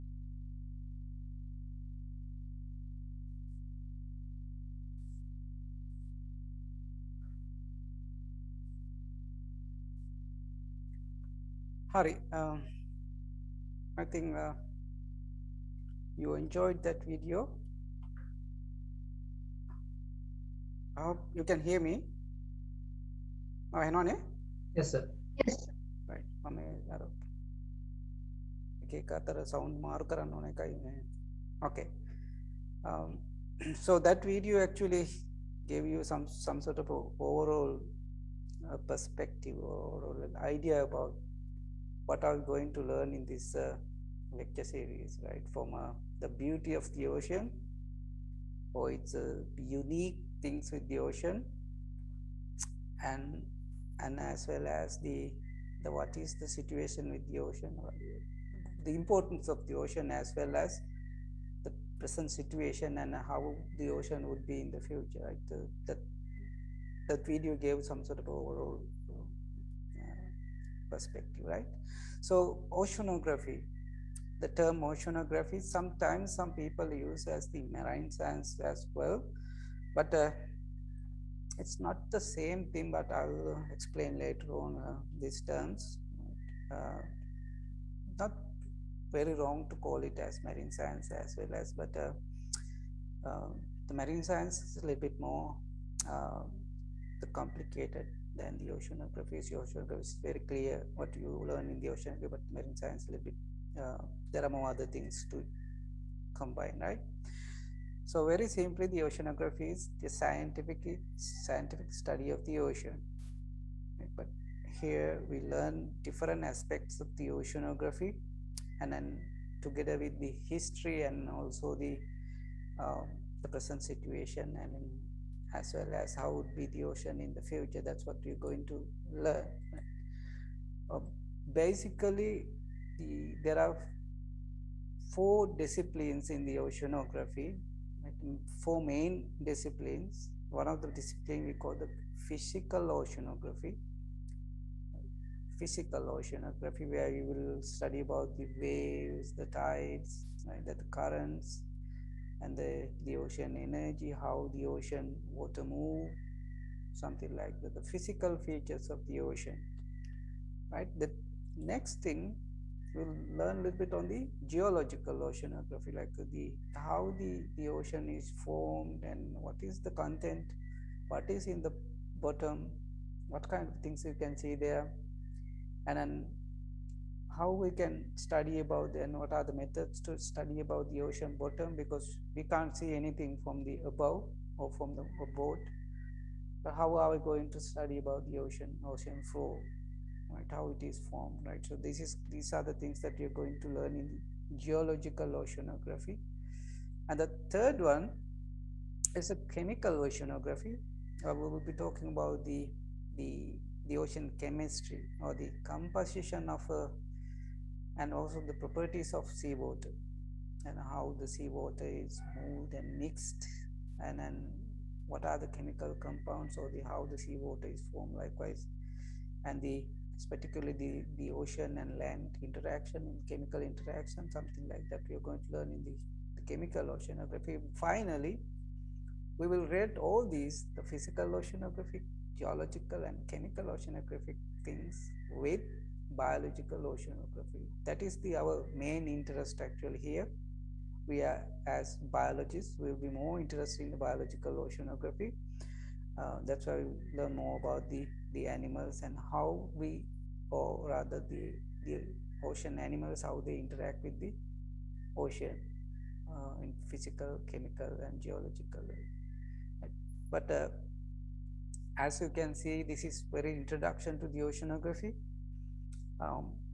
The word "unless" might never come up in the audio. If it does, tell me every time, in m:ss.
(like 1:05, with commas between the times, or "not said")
not said.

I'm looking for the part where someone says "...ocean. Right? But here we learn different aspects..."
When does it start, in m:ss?
1:52.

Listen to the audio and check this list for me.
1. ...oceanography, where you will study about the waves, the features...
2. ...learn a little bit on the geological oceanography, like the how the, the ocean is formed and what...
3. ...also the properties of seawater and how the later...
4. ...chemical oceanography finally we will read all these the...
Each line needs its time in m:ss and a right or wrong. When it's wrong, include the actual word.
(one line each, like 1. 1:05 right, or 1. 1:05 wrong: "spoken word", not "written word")
1. 2:26 wrong: "tides", not "features"
2. 2:43 right
3. 3:28 wrong: "seawater", not "later"
4. 3:46 right.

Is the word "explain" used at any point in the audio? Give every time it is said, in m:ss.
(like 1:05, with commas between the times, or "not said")
1:23.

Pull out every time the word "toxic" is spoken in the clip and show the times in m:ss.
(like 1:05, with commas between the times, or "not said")
not said.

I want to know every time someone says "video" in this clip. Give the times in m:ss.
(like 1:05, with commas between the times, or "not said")
0:17, 0:34, 1:07.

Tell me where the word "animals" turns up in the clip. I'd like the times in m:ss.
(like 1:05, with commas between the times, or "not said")
4:08, 4:12.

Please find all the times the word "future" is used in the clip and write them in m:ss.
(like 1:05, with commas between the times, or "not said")
1:04, 2:07.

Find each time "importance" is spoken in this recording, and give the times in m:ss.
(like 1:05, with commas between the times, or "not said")
0:59.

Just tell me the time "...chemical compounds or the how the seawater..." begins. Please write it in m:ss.
3:35.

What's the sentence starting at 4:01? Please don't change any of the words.
We are as biologists, we'll be more interested in the biological oceanography.